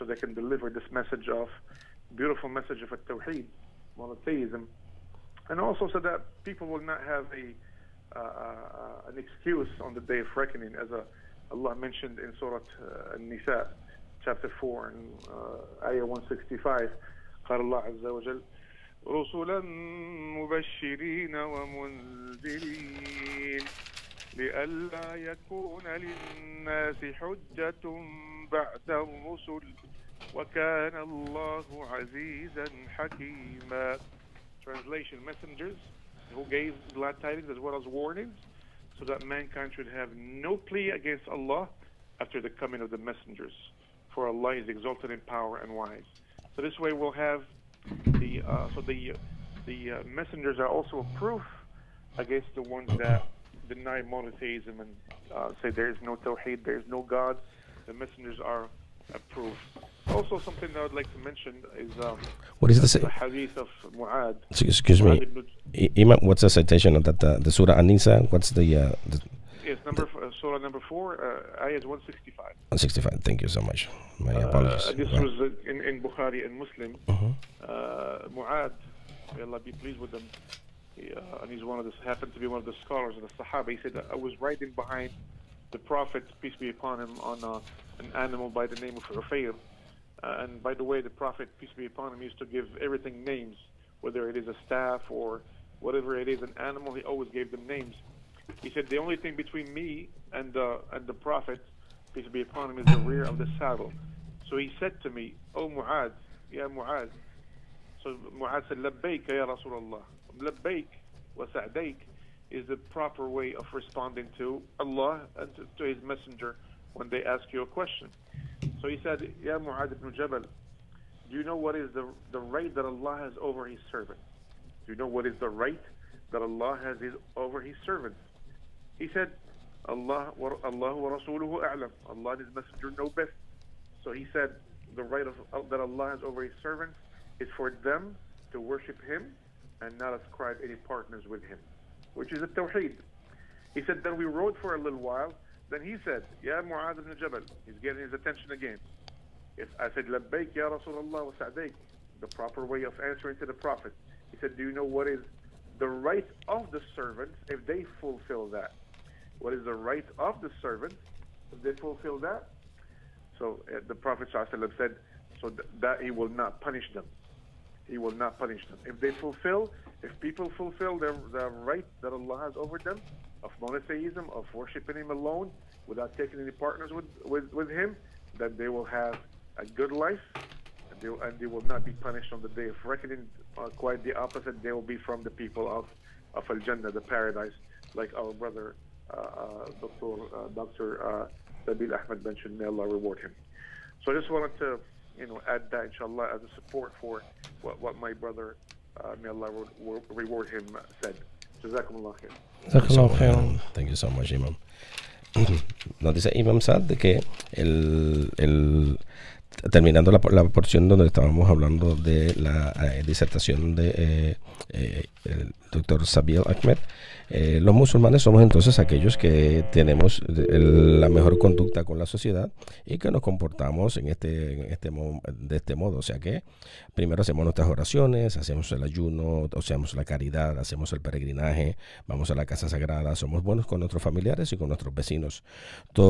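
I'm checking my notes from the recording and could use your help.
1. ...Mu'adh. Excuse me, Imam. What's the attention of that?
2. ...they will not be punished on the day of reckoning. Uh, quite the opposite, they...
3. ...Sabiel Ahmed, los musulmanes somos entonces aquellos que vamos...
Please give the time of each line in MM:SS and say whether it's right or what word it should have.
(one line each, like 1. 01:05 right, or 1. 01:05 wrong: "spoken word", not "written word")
1. 01:03 wrong: "citation", not "attention"
2. 03:01 right
3. 03:36 wrong: "tenemos", not "vamos".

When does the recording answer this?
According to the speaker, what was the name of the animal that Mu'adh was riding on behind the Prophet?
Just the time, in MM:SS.
01:29.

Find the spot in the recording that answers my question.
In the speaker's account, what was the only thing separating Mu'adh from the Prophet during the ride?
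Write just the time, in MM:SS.
01:42.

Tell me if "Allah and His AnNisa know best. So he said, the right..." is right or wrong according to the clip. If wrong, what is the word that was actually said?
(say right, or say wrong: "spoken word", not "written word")
wrong: "Messenger", not "AnNisa".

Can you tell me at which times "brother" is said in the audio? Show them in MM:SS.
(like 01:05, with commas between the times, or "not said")
03:08, 03:18.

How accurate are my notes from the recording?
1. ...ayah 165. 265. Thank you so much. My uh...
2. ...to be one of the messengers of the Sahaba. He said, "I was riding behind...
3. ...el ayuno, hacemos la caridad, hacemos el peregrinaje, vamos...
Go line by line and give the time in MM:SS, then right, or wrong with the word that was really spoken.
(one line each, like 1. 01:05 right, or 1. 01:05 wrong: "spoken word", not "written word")
1. 01:11 wrong: "165", not "265"
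2. 01:22 wrong: "scholars", not "messengers"
3. 03:48 right.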